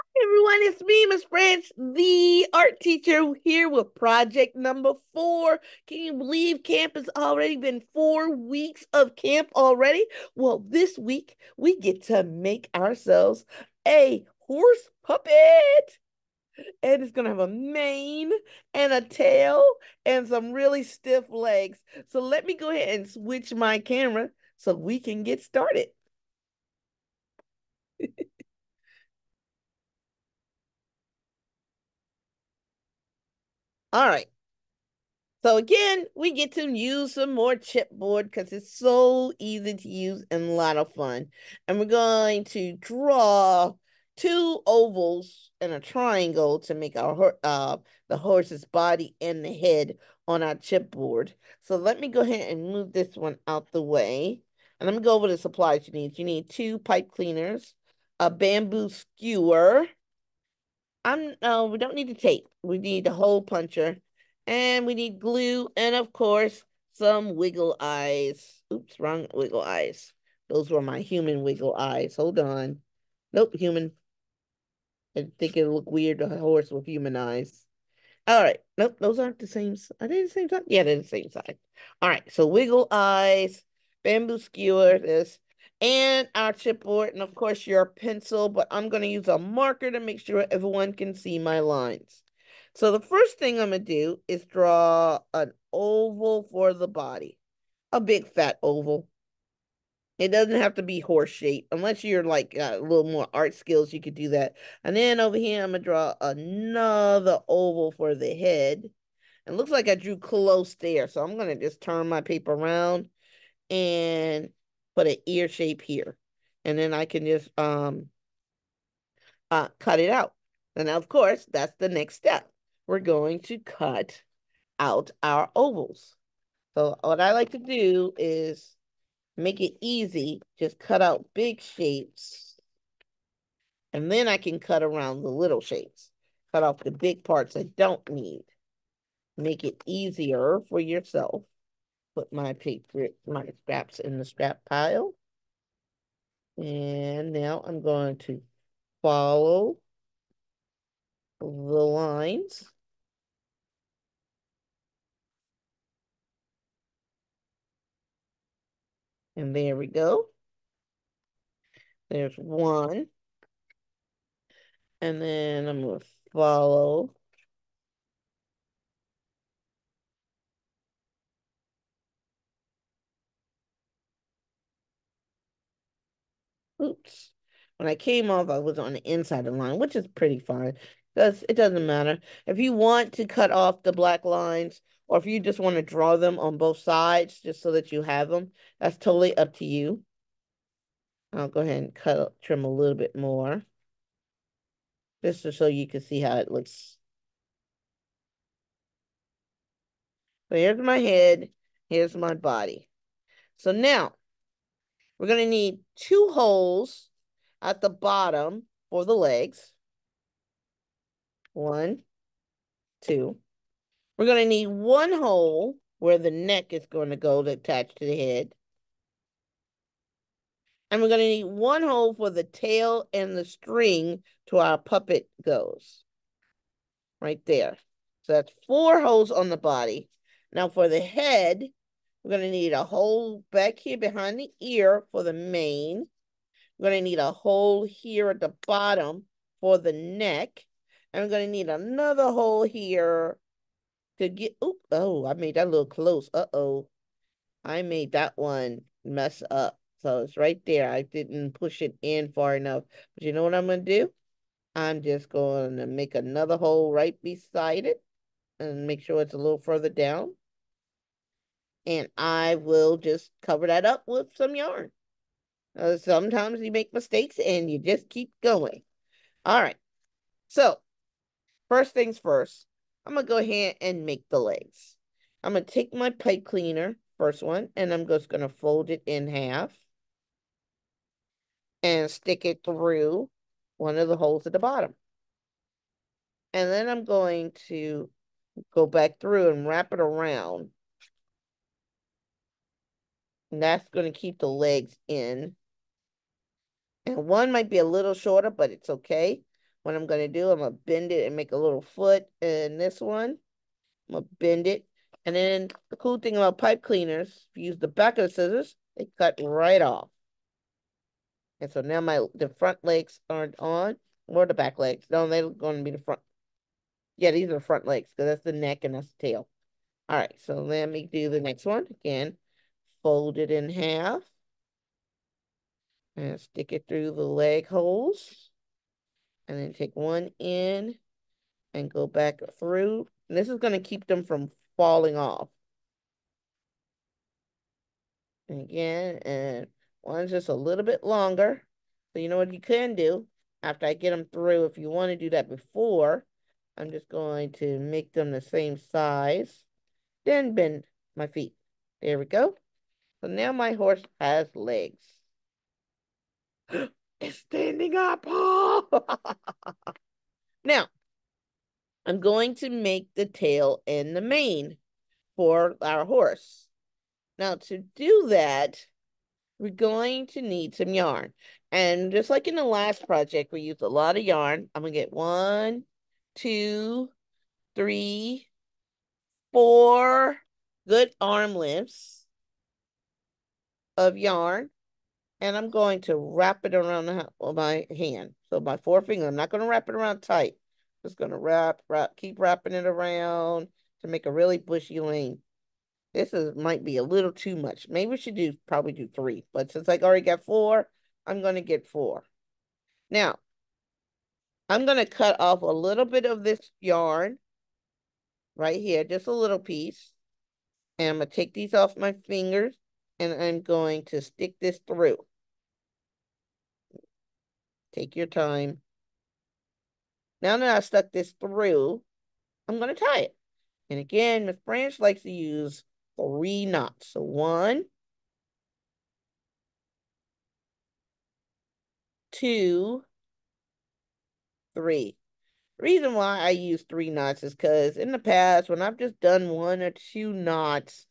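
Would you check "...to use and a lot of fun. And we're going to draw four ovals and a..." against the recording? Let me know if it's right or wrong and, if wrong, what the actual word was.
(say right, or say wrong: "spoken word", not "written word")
wrong: "two", not "four".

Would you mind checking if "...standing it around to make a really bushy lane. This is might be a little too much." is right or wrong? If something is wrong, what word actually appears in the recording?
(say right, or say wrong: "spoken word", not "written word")
wrong: "wrapping", not "standing".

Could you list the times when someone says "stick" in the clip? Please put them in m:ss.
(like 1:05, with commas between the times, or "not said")
4:42, 5:26, 6:54.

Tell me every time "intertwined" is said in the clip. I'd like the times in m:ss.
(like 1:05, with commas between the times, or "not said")
not said.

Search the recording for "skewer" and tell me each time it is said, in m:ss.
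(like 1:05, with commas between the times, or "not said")
0:58, 1:24.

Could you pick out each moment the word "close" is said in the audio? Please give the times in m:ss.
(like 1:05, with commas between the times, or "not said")
1:50, 4:05.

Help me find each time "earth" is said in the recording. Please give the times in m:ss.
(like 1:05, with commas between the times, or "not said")
not said.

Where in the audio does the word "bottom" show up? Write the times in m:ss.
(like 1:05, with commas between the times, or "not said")
3:27, 3:58, 4:44.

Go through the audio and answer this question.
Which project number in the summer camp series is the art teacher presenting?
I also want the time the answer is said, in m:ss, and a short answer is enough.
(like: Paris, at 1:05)
4, at 0:03.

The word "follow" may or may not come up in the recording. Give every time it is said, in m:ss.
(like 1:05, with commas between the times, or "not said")
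2:29, 2:46.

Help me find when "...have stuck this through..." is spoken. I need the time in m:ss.
7:00.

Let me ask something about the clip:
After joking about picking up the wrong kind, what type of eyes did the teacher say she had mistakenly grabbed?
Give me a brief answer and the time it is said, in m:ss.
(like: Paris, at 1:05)
human wiggle eyes, at 1:11.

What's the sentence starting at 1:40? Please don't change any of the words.
It doesn't have to be horse shaped unless you're like a little more art skills, you could do that.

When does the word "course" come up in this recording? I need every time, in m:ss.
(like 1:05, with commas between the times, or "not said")
1:06, 1:27, 2:01.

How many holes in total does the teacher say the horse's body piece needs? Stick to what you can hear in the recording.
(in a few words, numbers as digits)
4.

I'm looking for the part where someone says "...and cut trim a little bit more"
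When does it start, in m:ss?
3:11.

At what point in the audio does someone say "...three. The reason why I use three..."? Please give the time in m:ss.
7:14.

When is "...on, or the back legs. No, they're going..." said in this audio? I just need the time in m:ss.
5:13.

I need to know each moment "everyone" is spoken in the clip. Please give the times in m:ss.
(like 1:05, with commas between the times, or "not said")
0:00, 1:30.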